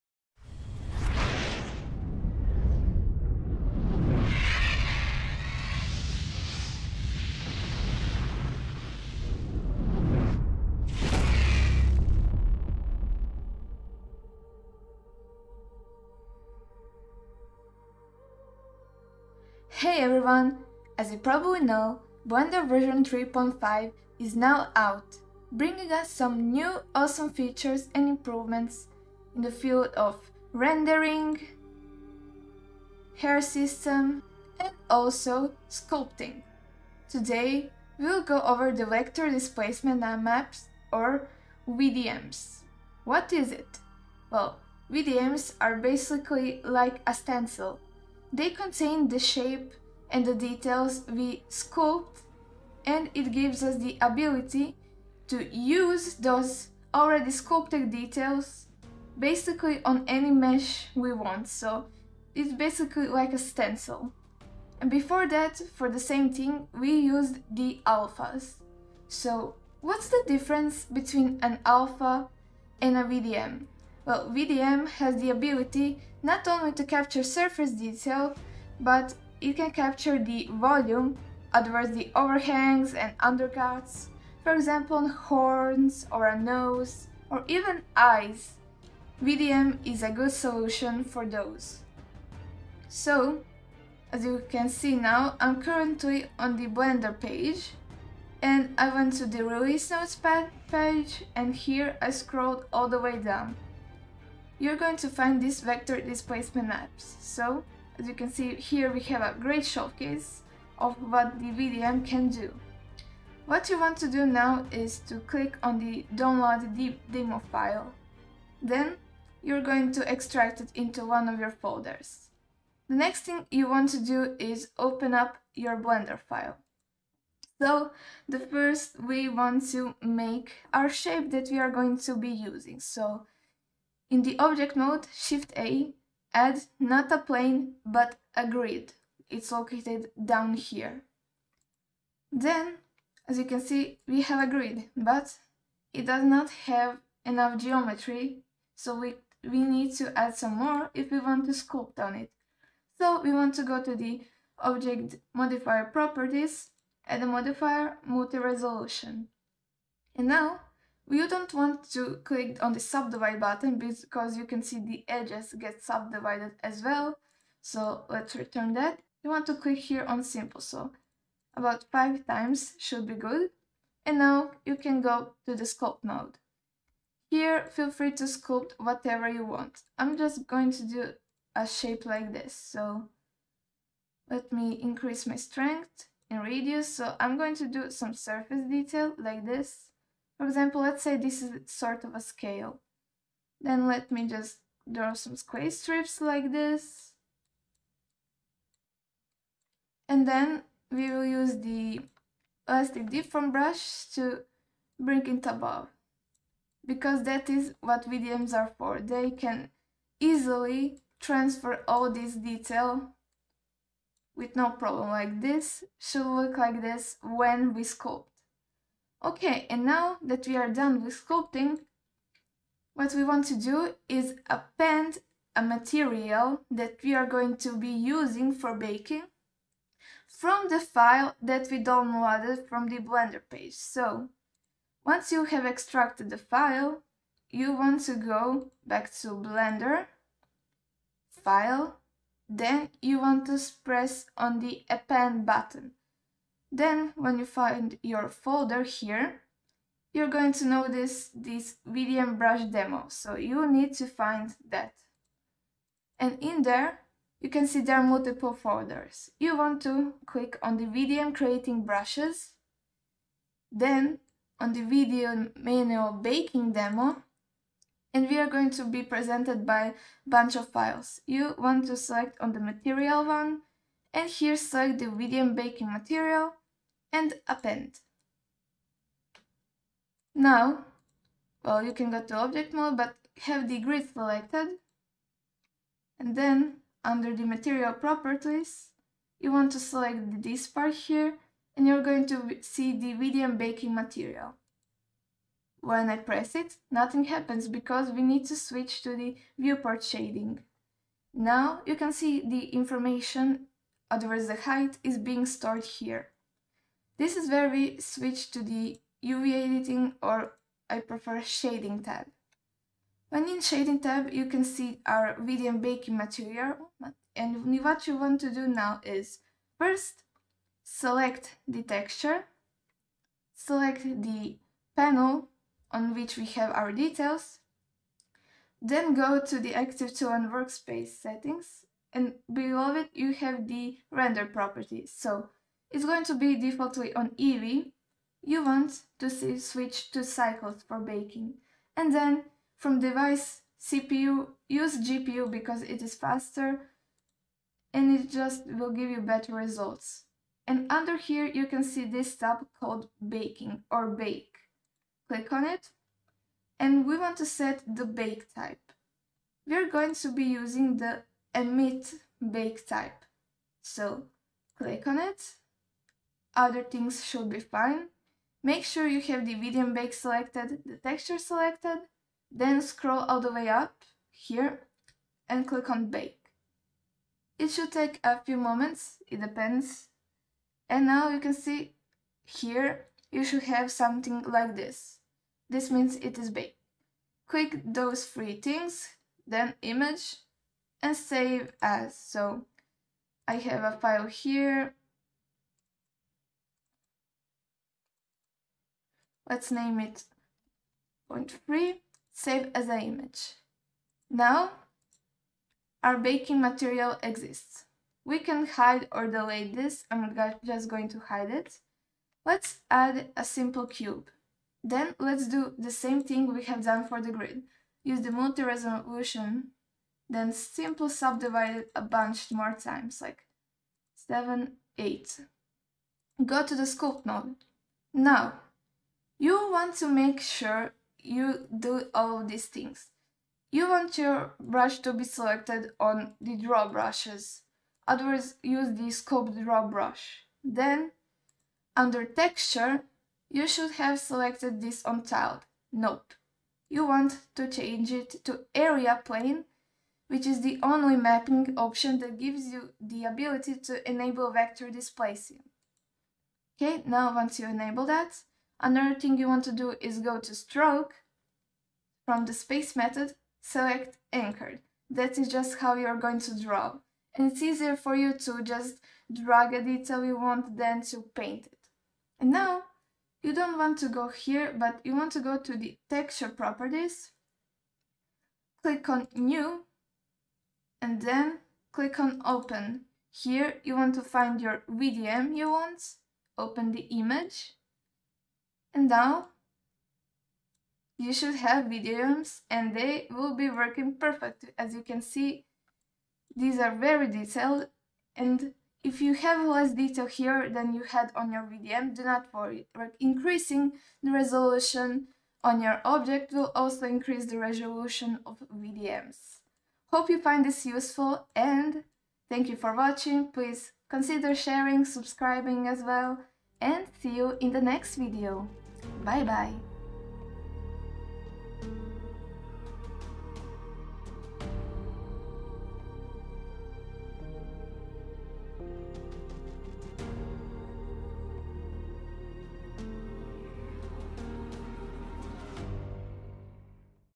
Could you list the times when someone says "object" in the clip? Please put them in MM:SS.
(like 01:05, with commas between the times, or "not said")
02:14, 02:34, 04:42, 08:26.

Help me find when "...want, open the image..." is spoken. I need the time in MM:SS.
08:05.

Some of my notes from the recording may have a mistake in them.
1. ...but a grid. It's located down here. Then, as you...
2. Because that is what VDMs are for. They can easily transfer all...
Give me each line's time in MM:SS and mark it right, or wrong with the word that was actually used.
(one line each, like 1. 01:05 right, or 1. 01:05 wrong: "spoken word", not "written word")
1. 02:17 right
2. 03:26 right.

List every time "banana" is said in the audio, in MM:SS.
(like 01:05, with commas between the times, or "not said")
not said.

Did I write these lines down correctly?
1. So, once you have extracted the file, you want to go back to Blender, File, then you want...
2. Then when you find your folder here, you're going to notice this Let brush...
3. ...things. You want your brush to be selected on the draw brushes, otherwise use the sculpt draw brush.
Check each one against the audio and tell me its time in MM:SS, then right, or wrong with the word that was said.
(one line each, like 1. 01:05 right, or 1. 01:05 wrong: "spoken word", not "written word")
1. 03:53 right
2. 04:06 wrong: "VDM", not "Let"
3. 07:12 right.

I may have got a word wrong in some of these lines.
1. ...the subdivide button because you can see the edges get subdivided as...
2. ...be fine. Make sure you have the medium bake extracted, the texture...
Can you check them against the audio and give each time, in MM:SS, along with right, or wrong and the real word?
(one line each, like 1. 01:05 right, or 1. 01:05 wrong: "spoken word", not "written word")
1. 02:42 right
2. 06:07 wrong: "selected", not "extracted".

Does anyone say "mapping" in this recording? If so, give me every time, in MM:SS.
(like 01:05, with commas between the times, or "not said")
07:31.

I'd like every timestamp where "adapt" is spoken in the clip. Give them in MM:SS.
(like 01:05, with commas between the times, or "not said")
not said.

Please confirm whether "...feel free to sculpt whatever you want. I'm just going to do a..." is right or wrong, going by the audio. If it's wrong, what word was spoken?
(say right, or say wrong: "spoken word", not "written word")
right.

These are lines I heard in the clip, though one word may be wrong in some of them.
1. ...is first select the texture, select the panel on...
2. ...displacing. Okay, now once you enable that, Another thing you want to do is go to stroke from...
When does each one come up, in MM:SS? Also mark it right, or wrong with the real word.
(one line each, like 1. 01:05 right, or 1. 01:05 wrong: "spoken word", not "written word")
1. 05:19 right
2. 07:34 right.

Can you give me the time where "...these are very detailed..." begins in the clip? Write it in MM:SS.
08:16.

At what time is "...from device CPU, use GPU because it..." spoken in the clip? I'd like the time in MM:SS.
05:42.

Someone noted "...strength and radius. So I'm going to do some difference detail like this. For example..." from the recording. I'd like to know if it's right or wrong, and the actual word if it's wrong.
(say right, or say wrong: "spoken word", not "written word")
wrong: "surface", not "difference".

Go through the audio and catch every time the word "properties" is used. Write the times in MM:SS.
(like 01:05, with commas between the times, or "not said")
02:35, 04:47, 05:34, 07:56.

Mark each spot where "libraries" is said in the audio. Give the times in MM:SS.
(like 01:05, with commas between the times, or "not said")
not said.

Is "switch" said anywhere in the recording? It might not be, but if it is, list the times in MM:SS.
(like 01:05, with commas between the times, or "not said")
04:58, 05:07, 05:39.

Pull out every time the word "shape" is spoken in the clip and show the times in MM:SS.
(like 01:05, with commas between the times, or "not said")
00:49, 02:10, 03:01.